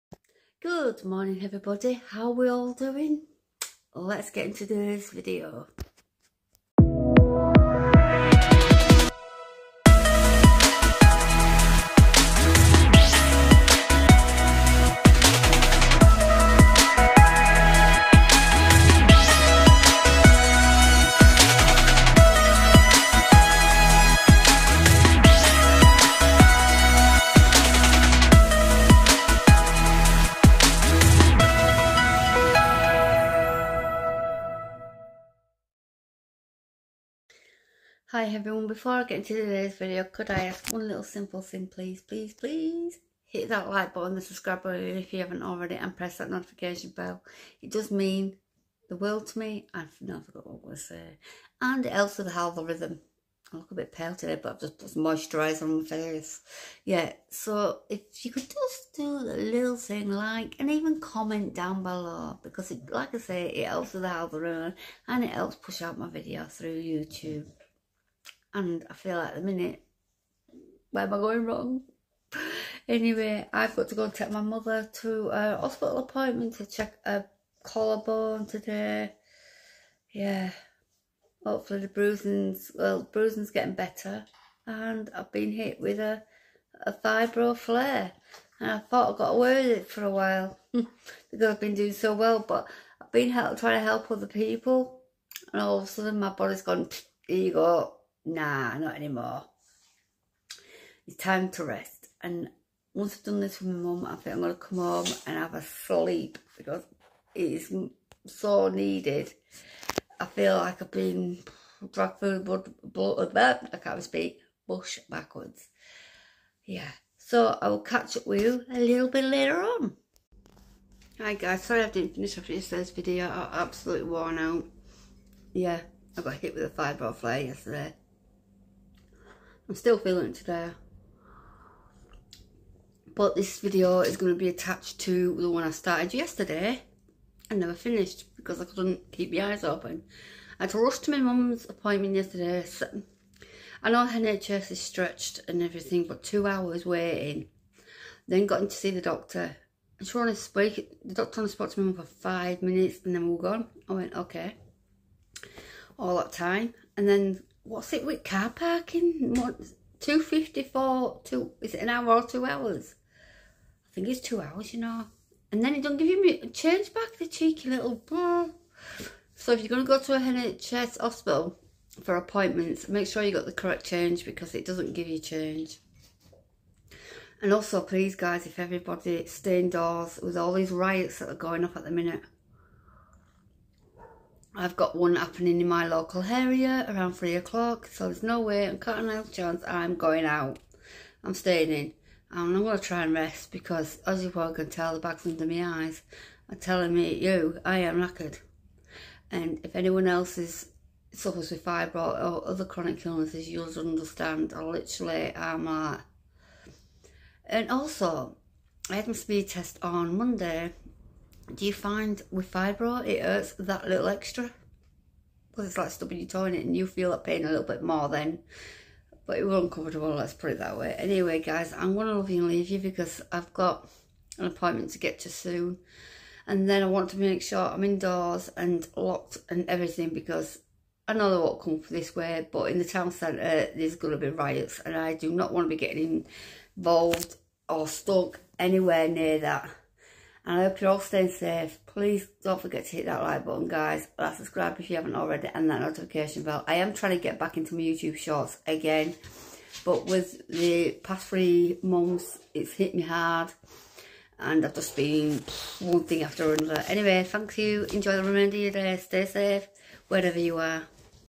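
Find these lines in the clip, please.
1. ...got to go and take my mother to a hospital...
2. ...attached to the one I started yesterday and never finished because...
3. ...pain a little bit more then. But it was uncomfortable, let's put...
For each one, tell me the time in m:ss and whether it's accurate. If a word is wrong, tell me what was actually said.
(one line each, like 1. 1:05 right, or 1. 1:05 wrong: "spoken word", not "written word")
1. 1:13 right
2. 2:14 right
3. 3:37 right.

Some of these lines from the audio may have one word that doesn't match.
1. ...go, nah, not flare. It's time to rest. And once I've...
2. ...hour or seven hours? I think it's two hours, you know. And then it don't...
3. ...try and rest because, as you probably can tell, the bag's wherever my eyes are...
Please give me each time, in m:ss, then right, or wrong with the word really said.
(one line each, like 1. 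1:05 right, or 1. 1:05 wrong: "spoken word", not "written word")
1. 1:37 wrong: "anymore", not "flare"
2. 2:41 wrong: "two", not "seven"
3. 3:12 wrong: "under", not "wherever".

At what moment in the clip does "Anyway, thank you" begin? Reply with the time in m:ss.
4:16.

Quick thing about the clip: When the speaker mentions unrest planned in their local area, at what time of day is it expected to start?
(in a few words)
3 o'clock.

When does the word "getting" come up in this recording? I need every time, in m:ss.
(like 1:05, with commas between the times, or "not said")
1:23, 3:55.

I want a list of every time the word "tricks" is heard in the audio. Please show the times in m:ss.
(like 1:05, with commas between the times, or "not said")
not said.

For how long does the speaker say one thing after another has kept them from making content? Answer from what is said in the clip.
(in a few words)
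3 months.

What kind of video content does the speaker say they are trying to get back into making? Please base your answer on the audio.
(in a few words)
YouTube shorts.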